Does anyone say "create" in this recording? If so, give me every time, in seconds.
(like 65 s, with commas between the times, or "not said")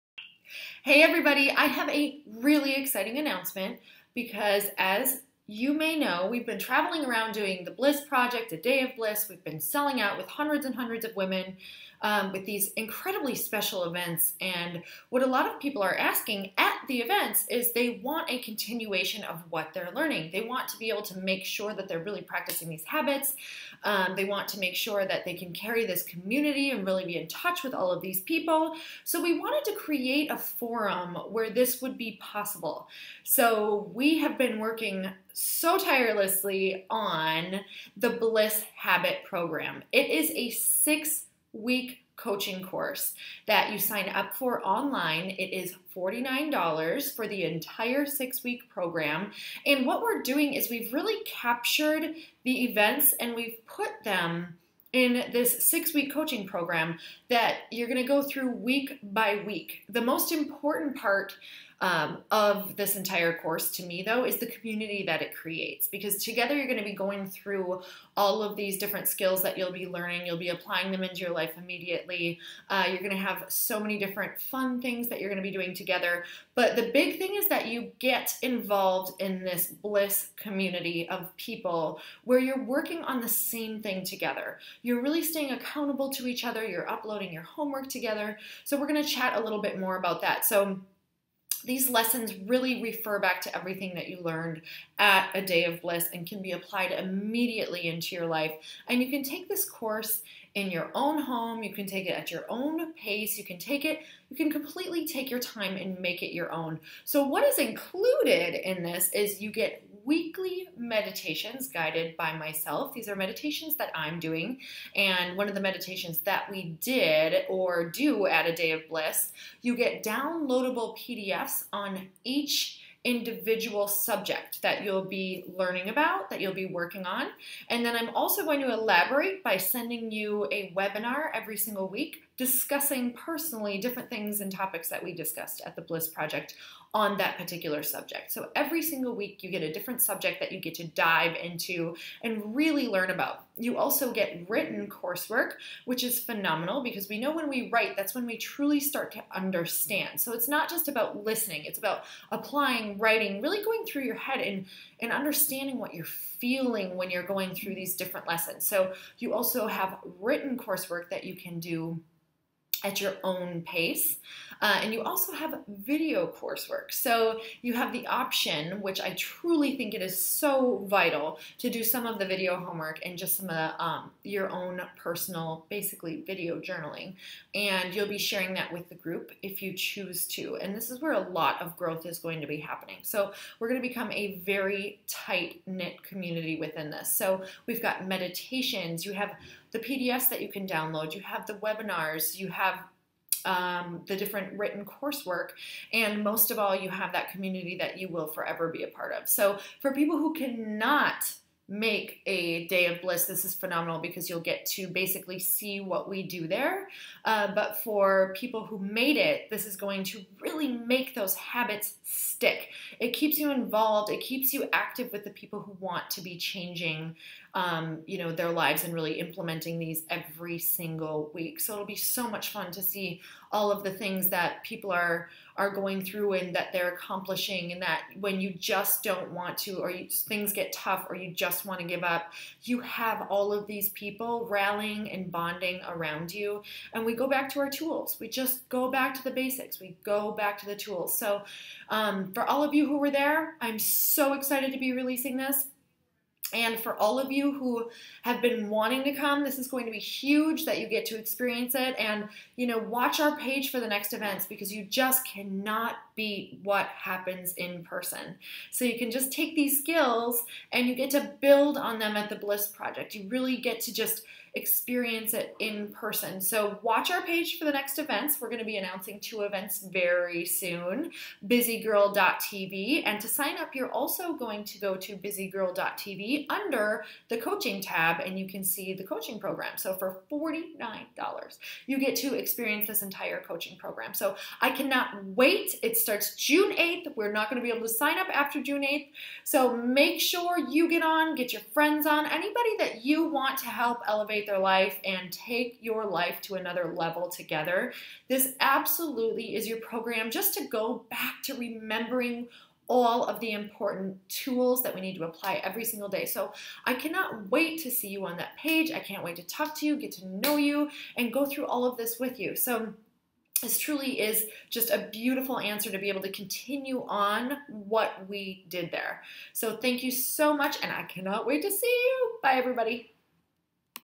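29 s, 65 s.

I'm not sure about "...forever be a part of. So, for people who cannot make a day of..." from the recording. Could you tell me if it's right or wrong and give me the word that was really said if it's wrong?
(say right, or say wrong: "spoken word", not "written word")
right.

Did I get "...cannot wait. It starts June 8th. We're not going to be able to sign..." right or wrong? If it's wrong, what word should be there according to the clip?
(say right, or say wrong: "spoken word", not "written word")
right.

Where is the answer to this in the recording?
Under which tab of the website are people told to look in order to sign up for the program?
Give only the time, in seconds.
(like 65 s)
277 s.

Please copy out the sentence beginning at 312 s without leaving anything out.
So this truly is just a beautiful answer to be able to continue on what we did there.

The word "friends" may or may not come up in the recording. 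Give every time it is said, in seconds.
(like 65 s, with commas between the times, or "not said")
291 s.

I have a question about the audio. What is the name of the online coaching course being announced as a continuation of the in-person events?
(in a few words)
Bliss Habit Program.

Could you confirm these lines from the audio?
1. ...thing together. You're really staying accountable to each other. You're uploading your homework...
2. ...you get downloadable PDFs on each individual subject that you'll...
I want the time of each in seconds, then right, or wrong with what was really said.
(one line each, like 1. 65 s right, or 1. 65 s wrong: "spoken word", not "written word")
1. 83 s right
2. 119 s right.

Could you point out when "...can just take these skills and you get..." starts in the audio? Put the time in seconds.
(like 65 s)
258 s.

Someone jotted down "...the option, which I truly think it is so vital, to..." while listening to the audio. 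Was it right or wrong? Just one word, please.
right.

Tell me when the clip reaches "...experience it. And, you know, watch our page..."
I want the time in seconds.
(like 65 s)
251 s.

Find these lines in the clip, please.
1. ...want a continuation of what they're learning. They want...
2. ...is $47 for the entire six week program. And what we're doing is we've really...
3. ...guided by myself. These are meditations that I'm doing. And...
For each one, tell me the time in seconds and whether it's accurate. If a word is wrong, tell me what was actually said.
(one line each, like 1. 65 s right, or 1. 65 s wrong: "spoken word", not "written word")
1. 18 s right
2. 45 s wrong: "49", not "47"
3. 111 s right.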